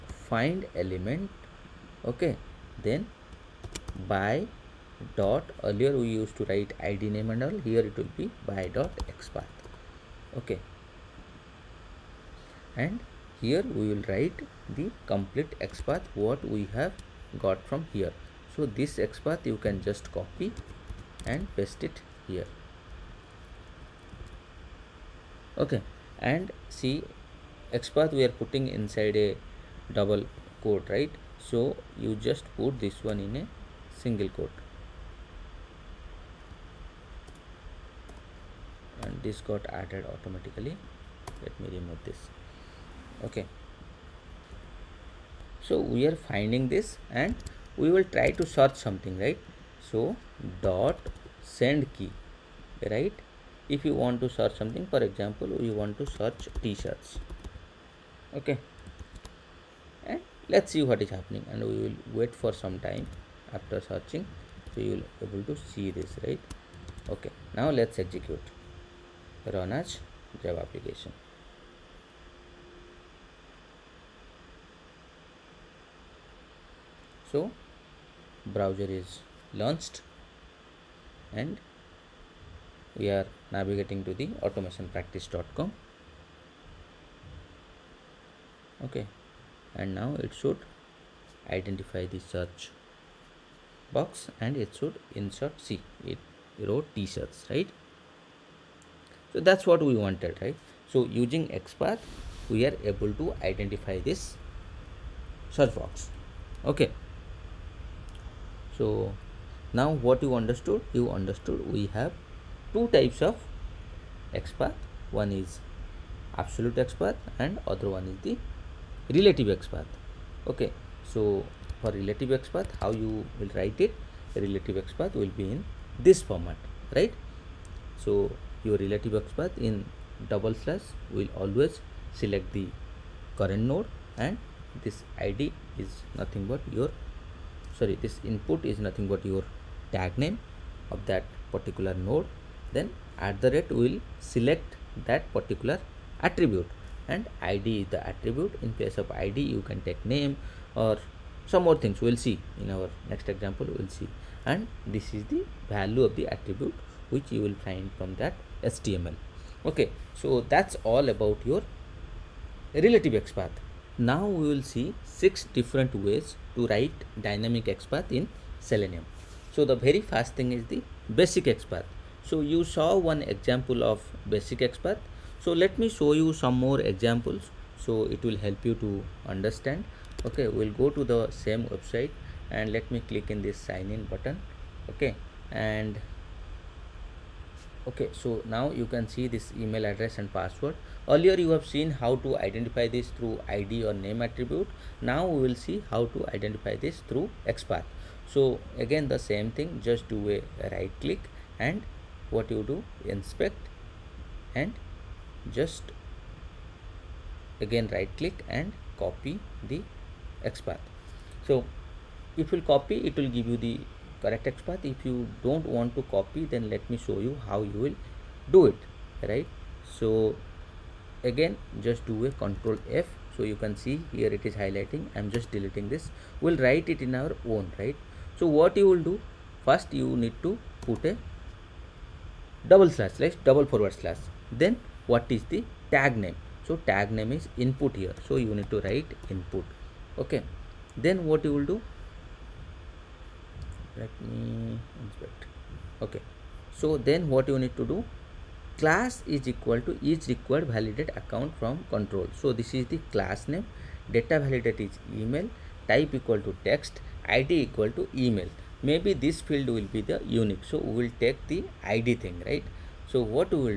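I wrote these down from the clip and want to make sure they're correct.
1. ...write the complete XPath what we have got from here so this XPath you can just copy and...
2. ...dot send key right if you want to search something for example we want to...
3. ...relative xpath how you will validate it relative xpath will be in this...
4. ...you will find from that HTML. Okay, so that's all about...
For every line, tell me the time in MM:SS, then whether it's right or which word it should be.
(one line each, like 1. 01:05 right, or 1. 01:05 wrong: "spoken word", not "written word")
1. 00:14 right
2. 00:50 right
3. 02:01 wrong: "write", not "validate"
4. 02:37 right.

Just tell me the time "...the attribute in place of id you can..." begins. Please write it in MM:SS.
02:27.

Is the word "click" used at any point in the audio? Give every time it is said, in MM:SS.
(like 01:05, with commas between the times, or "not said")
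03:03, 03:21, 03:28.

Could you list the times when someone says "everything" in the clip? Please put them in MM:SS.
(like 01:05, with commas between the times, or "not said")
not said.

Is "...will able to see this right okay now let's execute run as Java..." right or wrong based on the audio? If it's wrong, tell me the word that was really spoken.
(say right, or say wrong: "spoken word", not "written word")
right.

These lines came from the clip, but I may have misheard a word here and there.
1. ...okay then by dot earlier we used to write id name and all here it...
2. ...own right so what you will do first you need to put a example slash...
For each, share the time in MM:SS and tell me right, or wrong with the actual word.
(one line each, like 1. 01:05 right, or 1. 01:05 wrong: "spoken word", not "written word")
1. 00:02 right
2. 03:47 wrong: "double", not "example".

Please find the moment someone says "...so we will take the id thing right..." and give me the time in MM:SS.
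04:20.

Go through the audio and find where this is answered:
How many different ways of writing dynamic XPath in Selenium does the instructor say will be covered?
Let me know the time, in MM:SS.
02:45.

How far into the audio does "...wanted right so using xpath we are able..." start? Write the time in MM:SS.
01:39.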